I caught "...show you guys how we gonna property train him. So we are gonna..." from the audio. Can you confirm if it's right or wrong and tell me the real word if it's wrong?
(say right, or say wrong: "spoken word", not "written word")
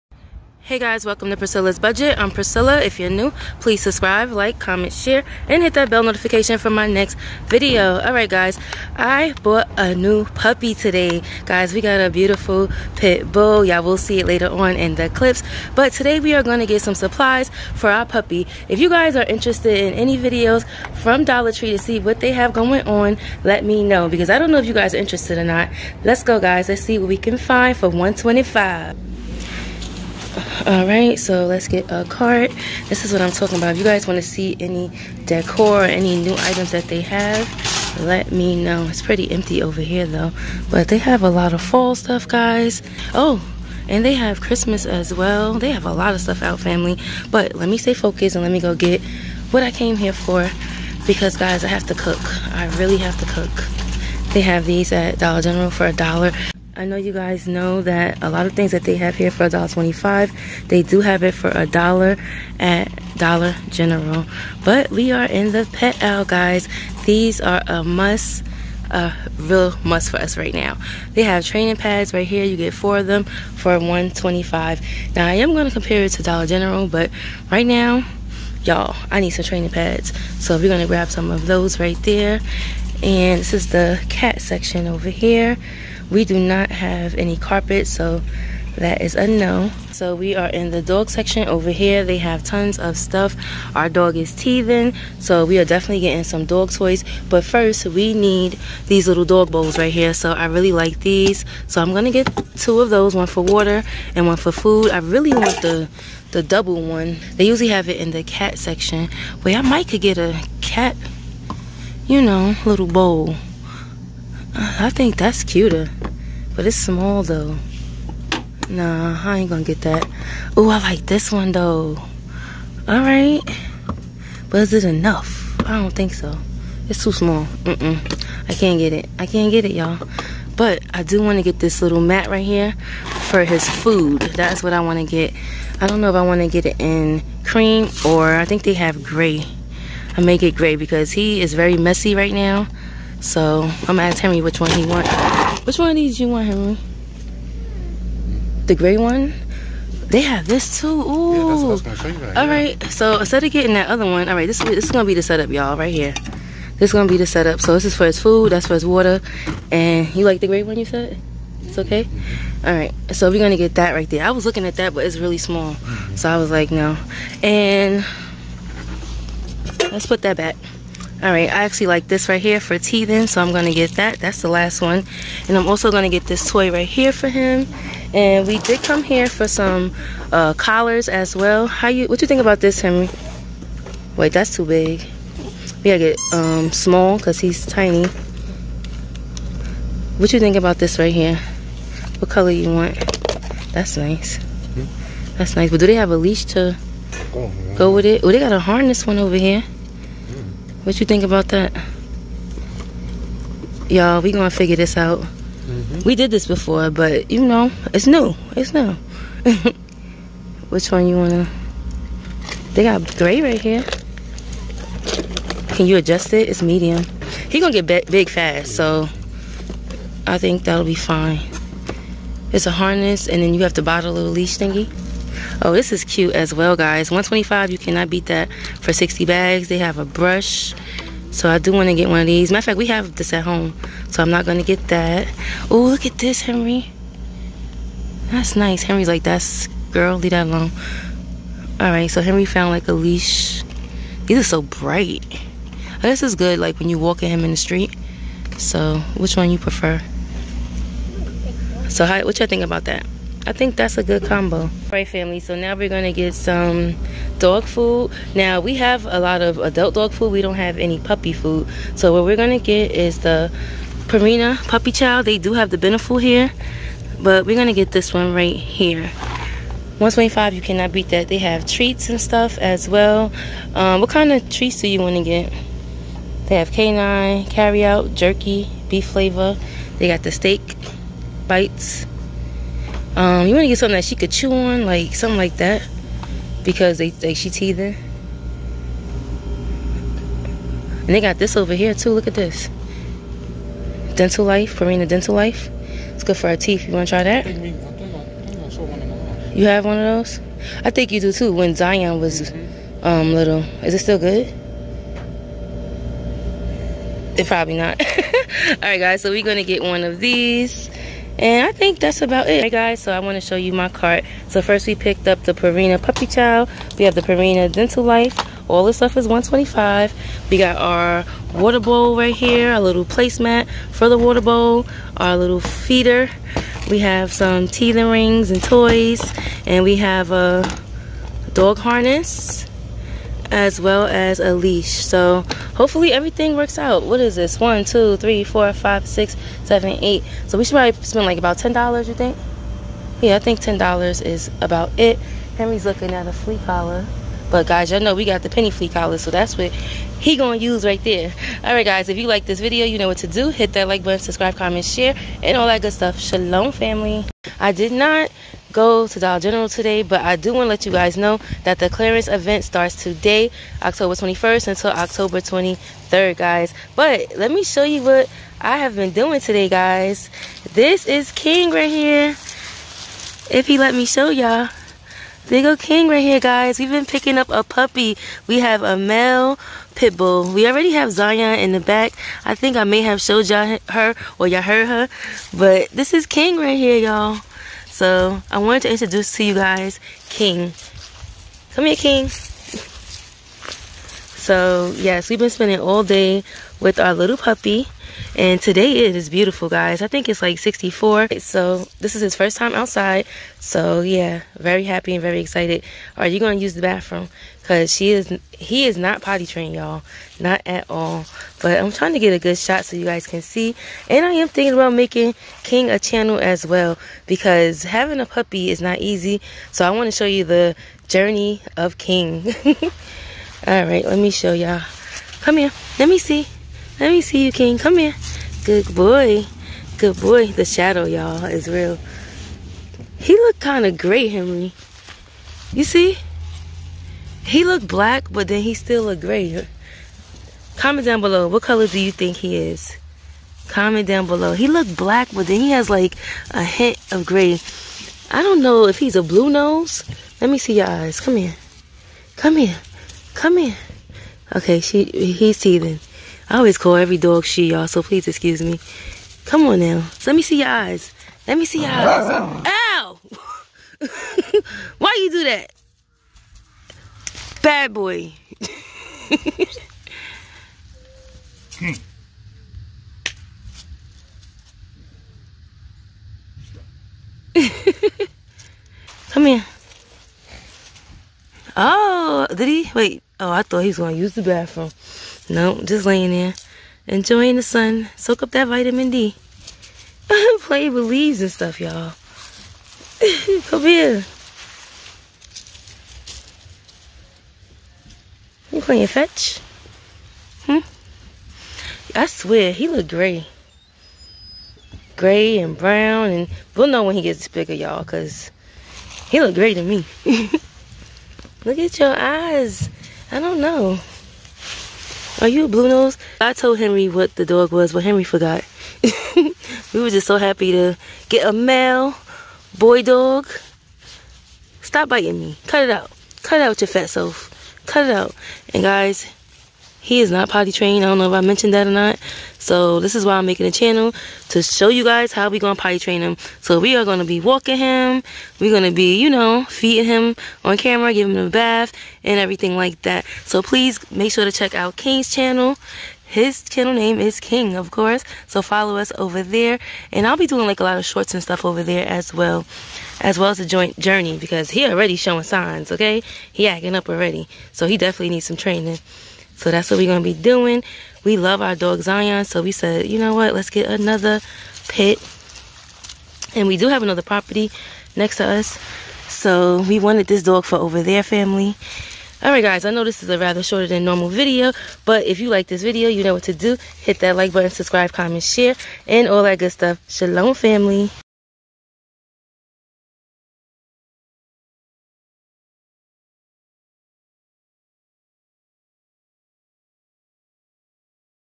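wrong: "potty", not "property".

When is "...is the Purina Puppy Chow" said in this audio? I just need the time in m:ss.
4:22.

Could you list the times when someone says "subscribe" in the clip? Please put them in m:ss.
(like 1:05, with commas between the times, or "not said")
0:03, 5:54, 9:37.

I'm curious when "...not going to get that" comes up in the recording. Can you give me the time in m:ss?
3:54.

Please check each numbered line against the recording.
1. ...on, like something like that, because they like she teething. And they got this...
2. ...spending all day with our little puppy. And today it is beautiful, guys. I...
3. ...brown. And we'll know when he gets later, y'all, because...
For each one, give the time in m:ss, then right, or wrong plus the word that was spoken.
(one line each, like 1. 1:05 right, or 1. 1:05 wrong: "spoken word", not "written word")
1. 4:44 right
2. 6:35 right
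3. 8:25 wrong: "bigger", not "later".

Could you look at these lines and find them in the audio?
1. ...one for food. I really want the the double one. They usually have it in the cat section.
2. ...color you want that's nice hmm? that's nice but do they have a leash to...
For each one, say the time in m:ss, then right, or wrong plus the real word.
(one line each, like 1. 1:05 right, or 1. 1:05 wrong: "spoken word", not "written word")
1. 1:44 right
2. 3:12 right.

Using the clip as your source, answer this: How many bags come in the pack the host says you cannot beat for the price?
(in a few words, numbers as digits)
60.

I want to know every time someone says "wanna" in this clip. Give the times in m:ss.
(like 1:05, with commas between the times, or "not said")
3:31, 4:35.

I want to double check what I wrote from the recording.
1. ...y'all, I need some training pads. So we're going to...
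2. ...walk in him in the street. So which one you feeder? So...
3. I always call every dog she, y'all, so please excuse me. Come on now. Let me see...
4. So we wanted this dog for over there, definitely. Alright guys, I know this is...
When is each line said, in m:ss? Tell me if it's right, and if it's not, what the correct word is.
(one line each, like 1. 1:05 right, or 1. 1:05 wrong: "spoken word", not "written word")
1. 1:18 right
2. 4:06 wrong: "prefer", not "feeder"
3. 7:36 right
4. 9:29 wrong: "family", not "definitely".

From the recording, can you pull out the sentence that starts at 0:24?
Because I don't know if you guys are interested or not.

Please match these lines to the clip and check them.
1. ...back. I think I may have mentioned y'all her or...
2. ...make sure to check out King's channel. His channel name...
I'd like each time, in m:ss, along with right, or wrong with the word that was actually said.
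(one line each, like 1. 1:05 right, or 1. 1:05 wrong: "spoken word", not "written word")
1. 6:21 wrong: "showed", not "mentioned"
2. 9:04 right.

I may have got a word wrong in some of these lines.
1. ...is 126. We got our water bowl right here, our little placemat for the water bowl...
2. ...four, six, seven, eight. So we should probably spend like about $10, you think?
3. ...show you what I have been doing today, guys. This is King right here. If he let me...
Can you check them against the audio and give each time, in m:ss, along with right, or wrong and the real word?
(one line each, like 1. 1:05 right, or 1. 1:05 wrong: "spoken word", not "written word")
1. 5:19 wrong: "125", not "126"
2. 5:38 wrong: "five", not "four"
3. 6:07 right.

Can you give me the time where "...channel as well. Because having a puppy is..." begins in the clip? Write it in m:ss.
6:55.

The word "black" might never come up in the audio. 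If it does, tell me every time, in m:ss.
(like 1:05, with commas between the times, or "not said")
7:17, 7:24.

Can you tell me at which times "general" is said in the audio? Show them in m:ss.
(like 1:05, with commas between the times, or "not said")
0:55, 1:03, 1:16, 5:59.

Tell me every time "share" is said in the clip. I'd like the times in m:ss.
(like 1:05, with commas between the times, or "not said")
0:04, 5:54, 9:38.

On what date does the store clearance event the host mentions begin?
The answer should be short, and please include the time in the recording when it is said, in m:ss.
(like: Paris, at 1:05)
October 21st, at 6:03.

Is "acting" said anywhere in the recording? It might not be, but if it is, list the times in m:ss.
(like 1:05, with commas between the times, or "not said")
9:16.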